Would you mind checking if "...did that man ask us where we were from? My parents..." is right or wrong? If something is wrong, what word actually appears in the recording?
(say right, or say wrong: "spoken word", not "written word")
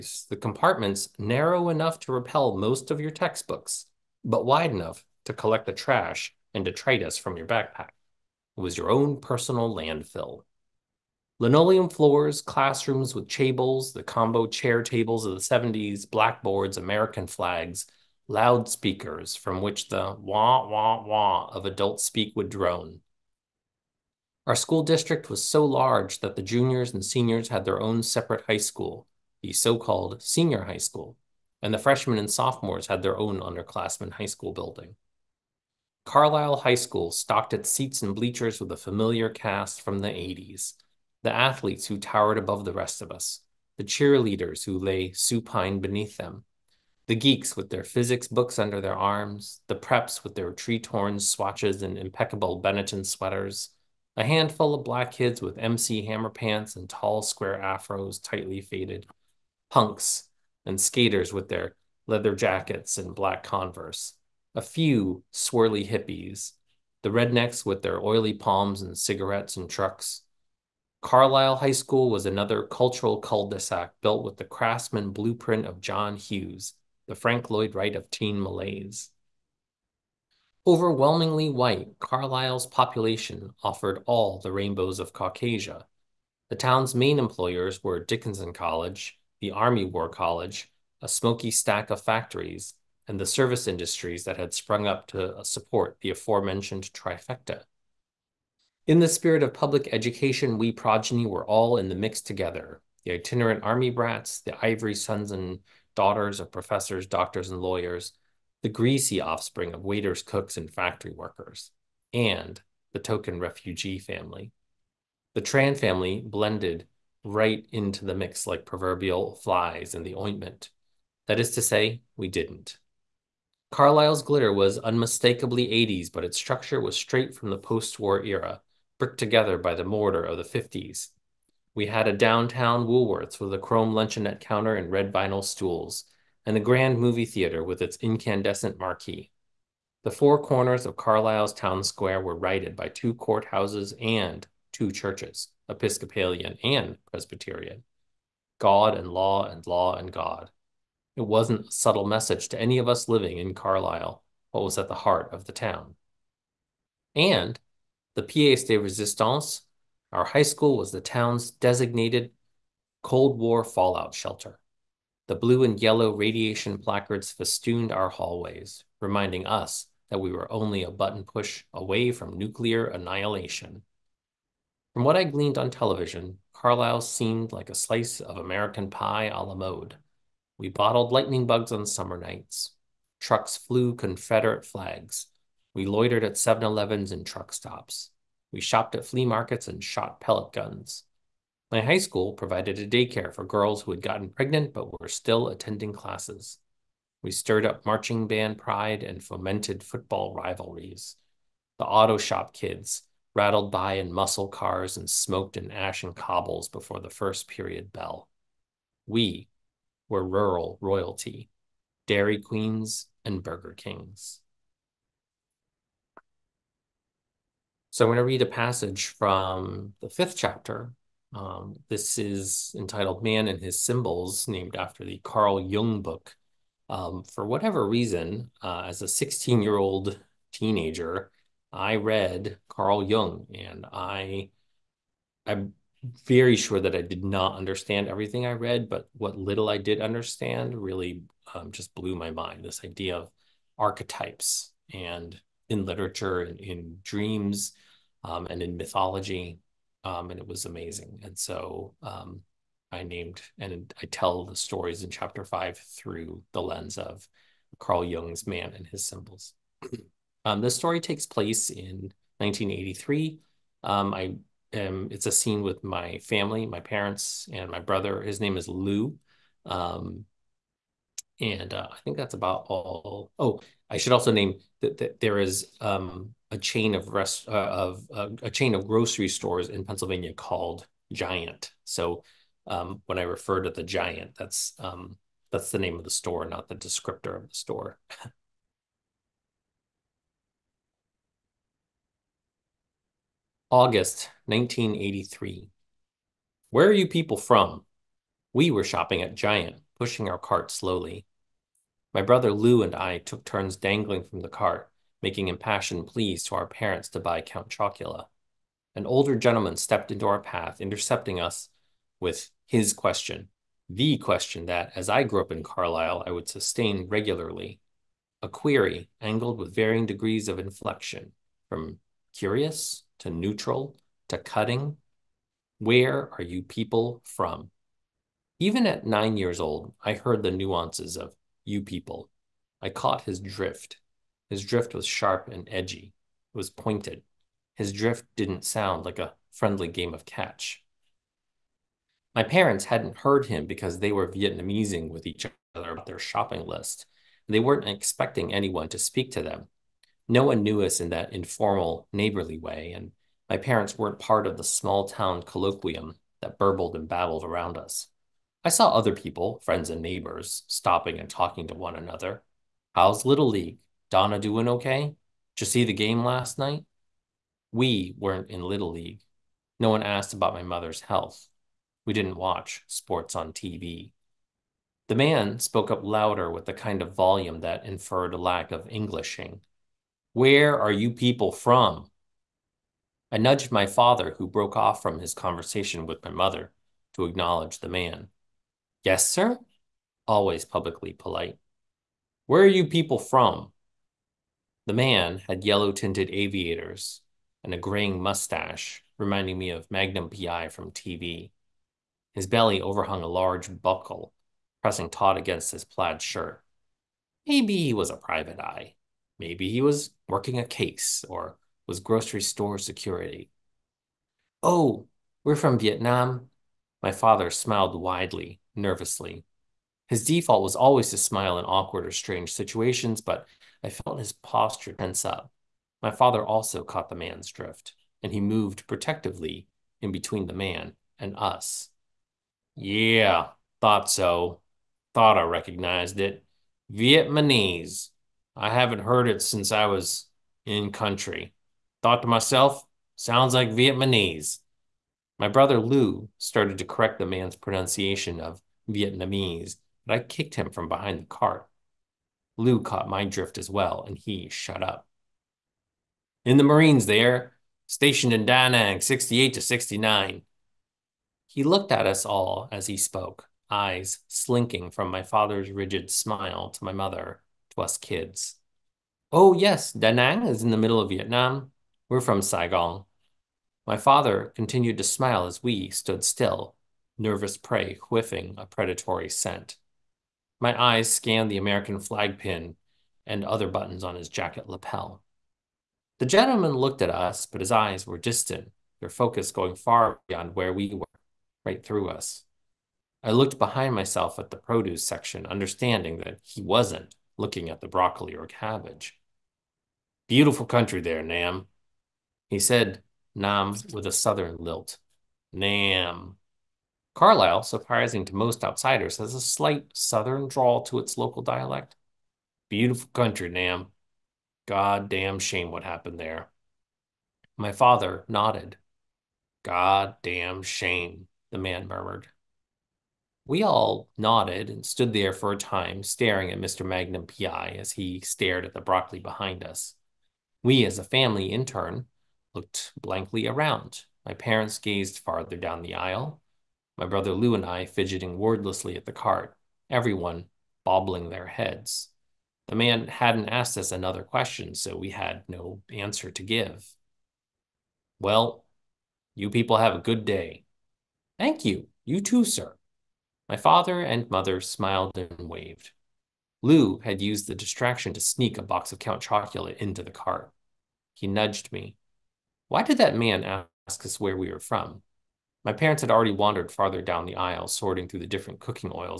right.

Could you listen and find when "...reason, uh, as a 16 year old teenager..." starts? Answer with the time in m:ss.
3:47.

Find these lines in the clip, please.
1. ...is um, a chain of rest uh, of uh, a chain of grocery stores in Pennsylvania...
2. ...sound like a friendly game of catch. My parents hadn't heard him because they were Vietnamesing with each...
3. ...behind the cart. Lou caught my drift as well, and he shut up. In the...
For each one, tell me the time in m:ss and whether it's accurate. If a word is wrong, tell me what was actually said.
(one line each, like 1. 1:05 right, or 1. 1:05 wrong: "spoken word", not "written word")
1. 4:35 right
2. 5:38 right
3. 7:30 right.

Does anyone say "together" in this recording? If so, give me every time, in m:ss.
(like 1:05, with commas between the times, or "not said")
1:42, 2:09.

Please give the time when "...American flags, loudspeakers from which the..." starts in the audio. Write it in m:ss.
0:16.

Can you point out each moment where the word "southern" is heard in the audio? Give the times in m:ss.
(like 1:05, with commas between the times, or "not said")
8:24, 8:29.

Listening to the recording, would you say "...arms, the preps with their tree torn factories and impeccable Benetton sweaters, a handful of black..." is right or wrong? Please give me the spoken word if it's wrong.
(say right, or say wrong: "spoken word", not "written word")
wrong: "swatches", not "factories".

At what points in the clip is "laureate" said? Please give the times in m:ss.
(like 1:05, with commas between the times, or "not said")
not said.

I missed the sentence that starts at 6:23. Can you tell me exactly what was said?
I nudged my father, who broke off from his conversation with my mother, to acknowledge the man.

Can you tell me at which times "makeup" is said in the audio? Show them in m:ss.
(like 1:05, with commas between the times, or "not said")
not said.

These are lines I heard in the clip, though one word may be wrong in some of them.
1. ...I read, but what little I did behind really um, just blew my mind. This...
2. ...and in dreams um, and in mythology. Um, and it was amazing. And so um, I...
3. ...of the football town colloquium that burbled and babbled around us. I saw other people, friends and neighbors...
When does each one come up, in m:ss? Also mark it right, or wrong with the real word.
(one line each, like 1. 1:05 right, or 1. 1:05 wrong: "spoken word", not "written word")
1. 3:58 wrong: "understand", not "behind"
2. 4:06 right
3. 5:54 wrong: "small", not "football".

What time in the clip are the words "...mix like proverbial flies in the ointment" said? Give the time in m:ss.
1:58.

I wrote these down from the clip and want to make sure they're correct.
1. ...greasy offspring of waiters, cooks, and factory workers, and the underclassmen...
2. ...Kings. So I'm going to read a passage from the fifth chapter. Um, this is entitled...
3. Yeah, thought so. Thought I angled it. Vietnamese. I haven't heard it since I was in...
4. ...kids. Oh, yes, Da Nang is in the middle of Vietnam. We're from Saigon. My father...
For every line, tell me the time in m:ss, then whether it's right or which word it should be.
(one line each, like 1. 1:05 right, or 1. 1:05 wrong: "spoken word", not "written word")
1. 1:48 wrong: "token", not "underclassmen"
2. 3:33 right
3. 7:12 wrong: "recognized", not "angled"
4. 7:47 right.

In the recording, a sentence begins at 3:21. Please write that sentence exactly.
The auto shop kids rattled by in muscle cars and smoked in ash and cobbles before the first period bell.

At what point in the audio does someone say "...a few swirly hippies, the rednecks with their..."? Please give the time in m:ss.
1:04.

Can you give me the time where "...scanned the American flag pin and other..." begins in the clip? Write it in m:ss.
8:01.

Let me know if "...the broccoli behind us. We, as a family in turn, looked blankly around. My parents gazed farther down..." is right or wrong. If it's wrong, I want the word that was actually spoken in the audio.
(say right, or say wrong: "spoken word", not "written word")
right.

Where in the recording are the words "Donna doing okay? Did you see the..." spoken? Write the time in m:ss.
6:04.